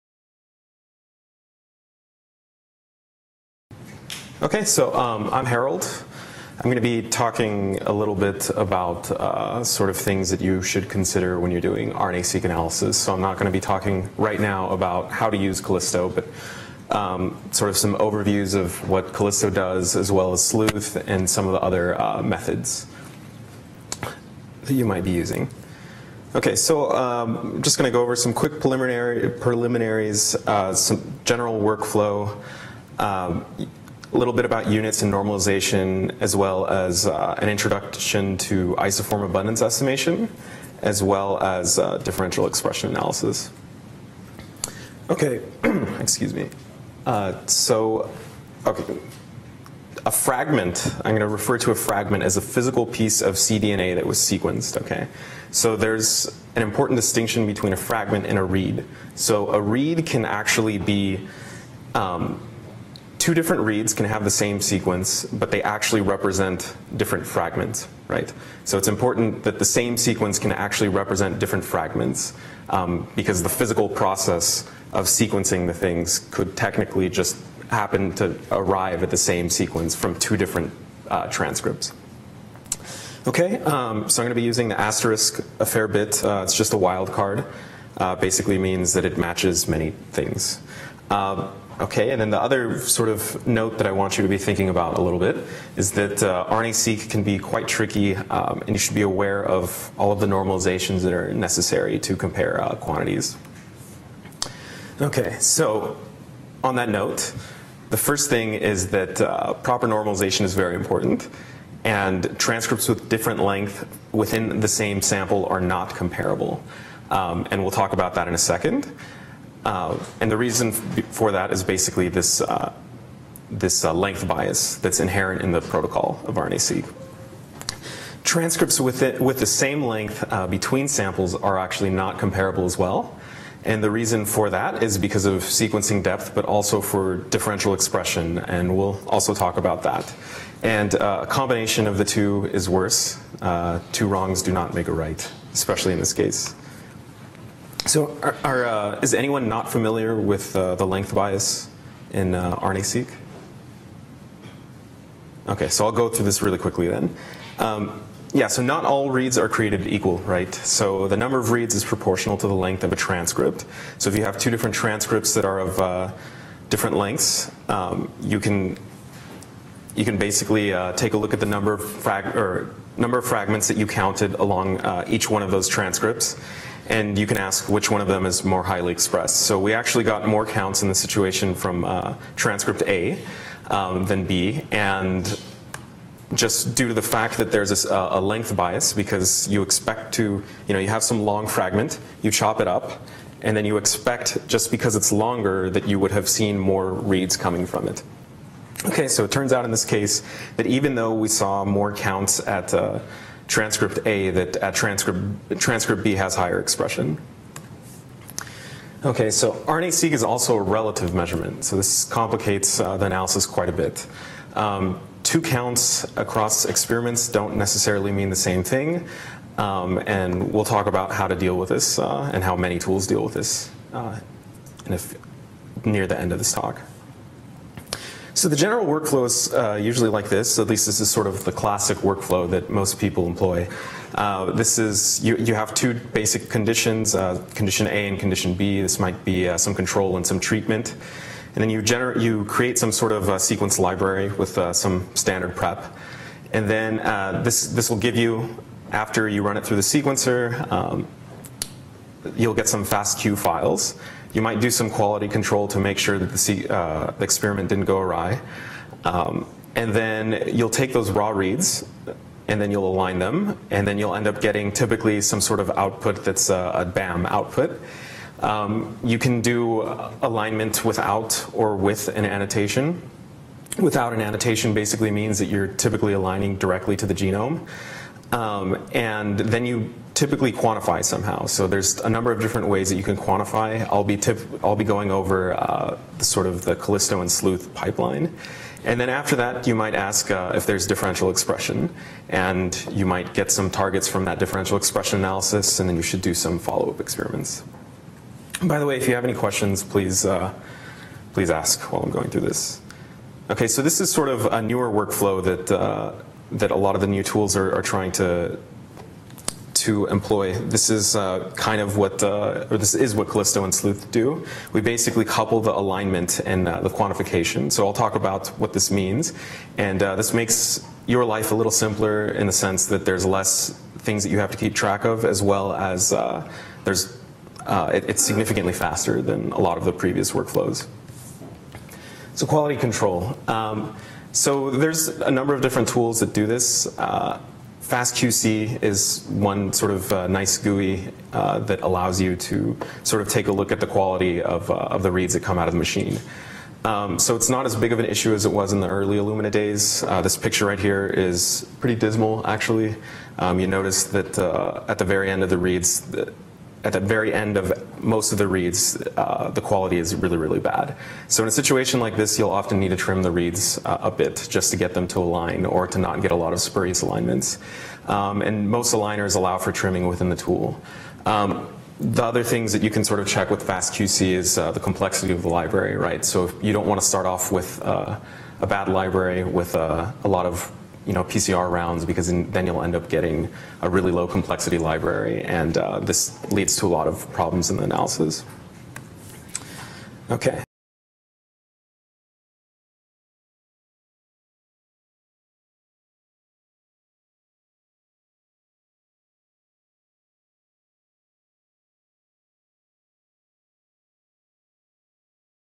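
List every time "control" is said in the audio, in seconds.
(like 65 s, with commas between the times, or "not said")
239 s, 255 s, 332 s.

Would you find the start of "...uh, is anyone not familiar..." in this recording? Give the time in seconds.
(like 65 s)
148 s.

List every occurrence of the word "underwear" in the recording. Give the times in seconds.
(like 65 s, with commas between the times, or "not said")
not said.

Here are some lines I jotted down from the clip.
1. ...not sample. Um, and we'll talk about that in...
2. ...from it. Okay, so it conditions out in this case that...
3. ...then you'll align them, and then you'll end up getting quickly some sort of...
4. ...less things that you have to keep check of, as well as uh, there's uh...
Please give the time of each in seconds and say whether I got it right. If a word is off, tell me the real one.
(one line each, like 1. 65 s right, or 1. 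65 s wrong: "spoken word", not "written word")
1. 115 s wrong: "comparable", not "sample"
2. 197 s wrong: "turns", not "conditions"
3. 262 s wrong: "typically", not "quickly"
4. 323 s wrong: "track", not "check".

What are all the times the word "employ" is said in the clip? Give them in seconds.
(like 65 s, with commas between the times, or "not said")
233 s, 310 s.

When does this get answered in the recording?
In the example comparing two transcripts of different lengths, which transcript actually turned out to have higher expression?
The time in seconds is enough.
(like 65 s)
205 s.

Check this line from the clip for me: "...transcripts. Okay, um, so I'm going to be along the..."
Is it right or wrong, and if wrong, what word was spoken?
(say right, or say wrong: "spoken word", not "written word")
wrong: "using", not "along".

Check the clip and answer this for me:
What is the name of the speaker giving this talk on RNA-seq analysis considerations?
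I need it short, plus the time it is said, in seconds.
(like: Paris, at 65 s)
Harold, at 5 s.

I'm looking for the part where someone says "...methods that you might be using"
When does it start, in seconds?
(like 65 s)
22 s.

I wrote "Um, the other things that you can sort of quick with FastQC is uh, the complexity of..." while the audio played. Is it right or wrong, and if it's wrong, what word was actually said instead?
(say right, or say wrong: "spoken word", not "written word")
wrong: "check", not "quick".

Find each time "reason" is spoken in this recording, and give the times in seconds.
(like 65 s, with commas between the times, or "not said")
120 s, 133 s.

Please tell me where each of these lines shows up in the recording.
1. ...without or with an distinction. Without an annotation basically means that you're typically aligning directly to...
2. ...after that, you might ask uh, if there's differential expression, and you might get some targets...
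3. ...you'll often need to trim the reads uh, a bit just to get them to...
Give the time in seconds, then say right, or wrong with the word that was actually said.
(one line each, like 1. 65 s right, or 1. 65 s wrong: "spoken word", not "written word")
1. 270 s wrong: "annotation", not "distinction"
2. 289 s right
3. 362 s right.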